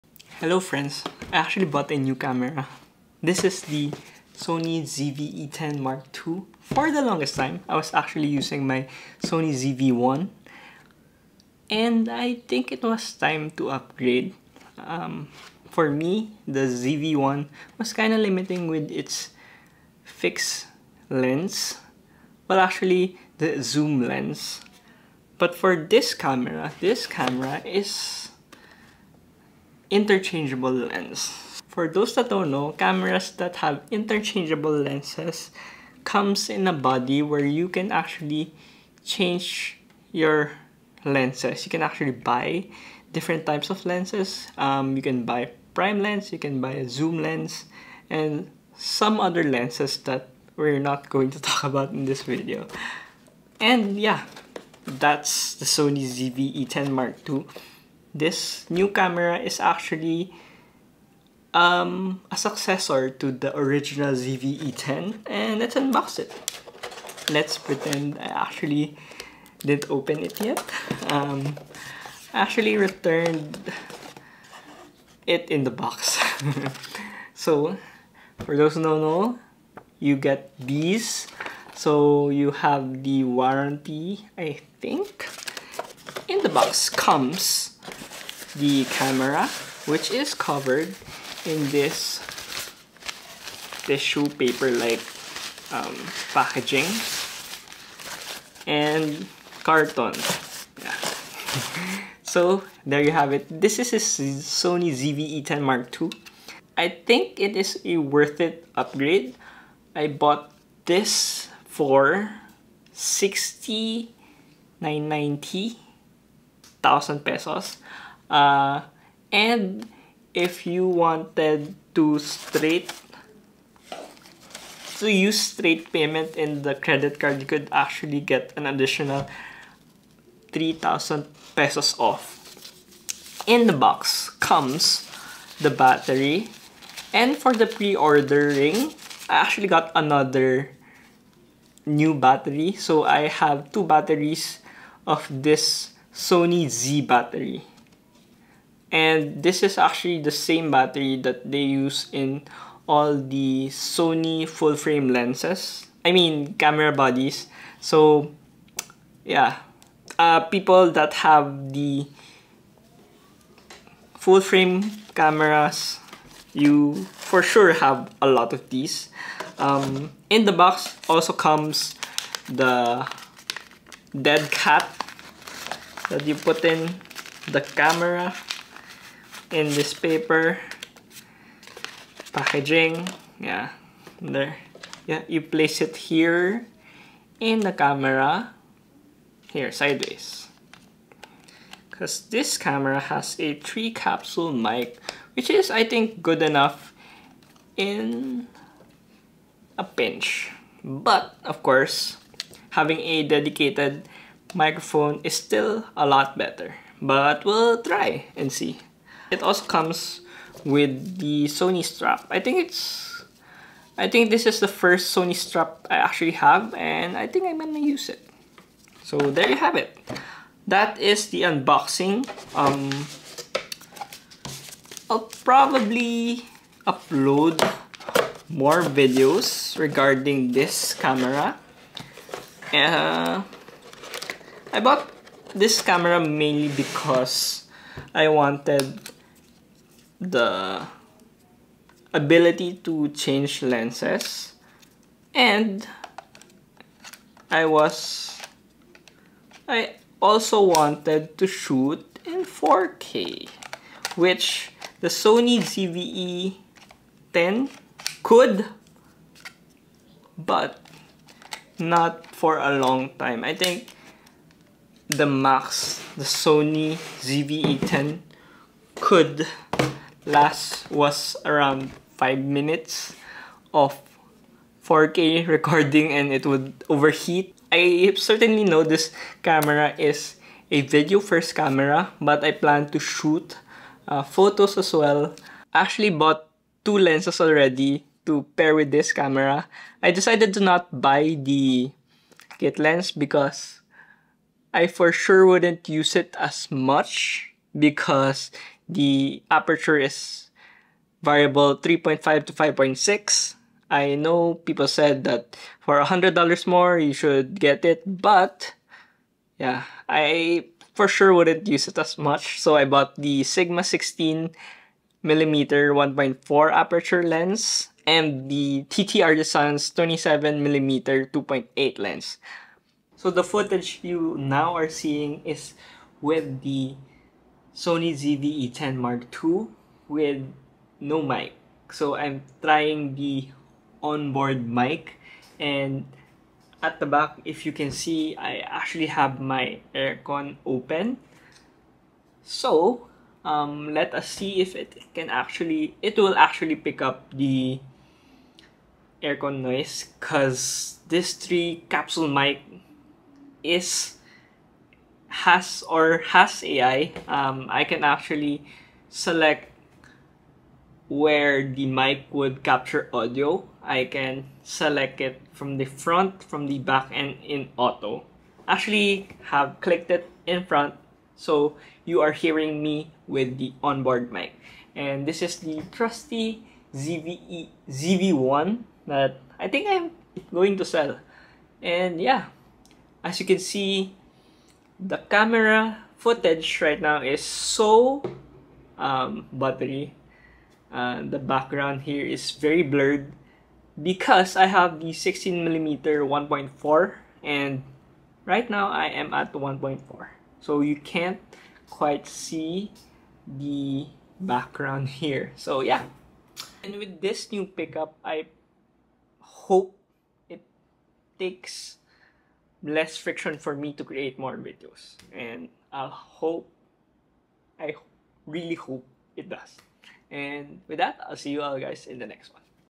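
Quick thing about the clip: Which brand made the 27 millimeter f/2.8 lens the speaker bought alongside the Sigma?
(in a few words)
TT Artisan.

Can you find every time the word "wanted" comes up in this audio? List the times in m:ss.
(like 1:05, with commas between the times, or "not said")
2:00, 3:58, 4:10.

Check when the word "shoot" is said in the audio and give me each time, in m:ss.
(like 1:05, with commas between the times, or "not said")
4:11, 4:42.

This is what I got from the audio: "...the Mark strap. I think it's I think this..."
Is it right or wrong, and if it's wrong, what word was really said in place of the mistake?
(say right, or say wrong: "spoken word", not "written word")
wrong: "Sony", not "Mark".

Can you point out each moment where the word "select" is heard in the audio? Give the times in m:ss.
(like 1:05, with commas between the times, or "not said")
5:59, 6:04.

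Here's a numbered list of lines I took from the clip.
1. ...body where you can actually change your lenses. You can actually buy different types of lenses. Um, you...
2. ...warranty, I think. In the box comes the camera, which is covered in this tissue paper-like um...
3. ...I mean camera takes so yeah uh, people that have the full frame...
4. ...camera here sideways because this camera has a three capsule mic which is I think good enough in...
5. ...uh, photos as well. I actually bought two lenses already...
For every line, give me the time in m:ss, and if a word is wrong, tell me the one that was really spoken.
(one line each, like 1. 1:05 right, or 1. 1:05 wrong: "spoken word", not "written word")
1. 0:36 right
2. 1:23 right
3. 2:36 wrong: "bodies", not "takes"
4. 3:07 right
5. 4:44 right.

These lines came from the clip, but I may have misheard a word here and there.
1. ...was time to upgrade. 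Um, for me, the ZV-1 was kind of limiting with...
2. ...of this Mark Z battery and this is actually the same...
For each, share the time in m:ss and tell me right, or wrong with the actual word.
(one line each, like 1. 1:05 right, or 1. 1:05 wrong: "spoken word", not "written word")
1. 0:12 right
2. 2:25 wrong: "Sony", not "Mark".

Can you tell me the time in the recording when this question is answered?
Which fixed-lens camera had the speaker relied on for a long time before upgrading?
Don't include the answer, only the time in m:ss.
0:09.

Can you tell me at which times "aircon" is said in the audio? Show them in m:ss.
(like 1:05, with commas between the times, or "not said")
5:39, 5:49.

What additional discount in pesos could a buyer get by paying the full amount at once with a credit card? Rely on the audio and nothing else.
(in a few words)
3,000 pesos.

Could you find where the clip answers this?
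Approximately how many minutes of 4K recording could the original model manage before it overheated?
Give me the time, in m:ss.
4:32.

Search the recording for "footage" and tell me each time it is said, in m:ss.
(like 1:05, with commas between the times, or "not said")
5:23, 6:26.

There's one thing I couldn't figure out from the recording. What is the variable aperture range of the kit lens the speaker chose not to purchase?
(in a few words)
3.5 to 5.6.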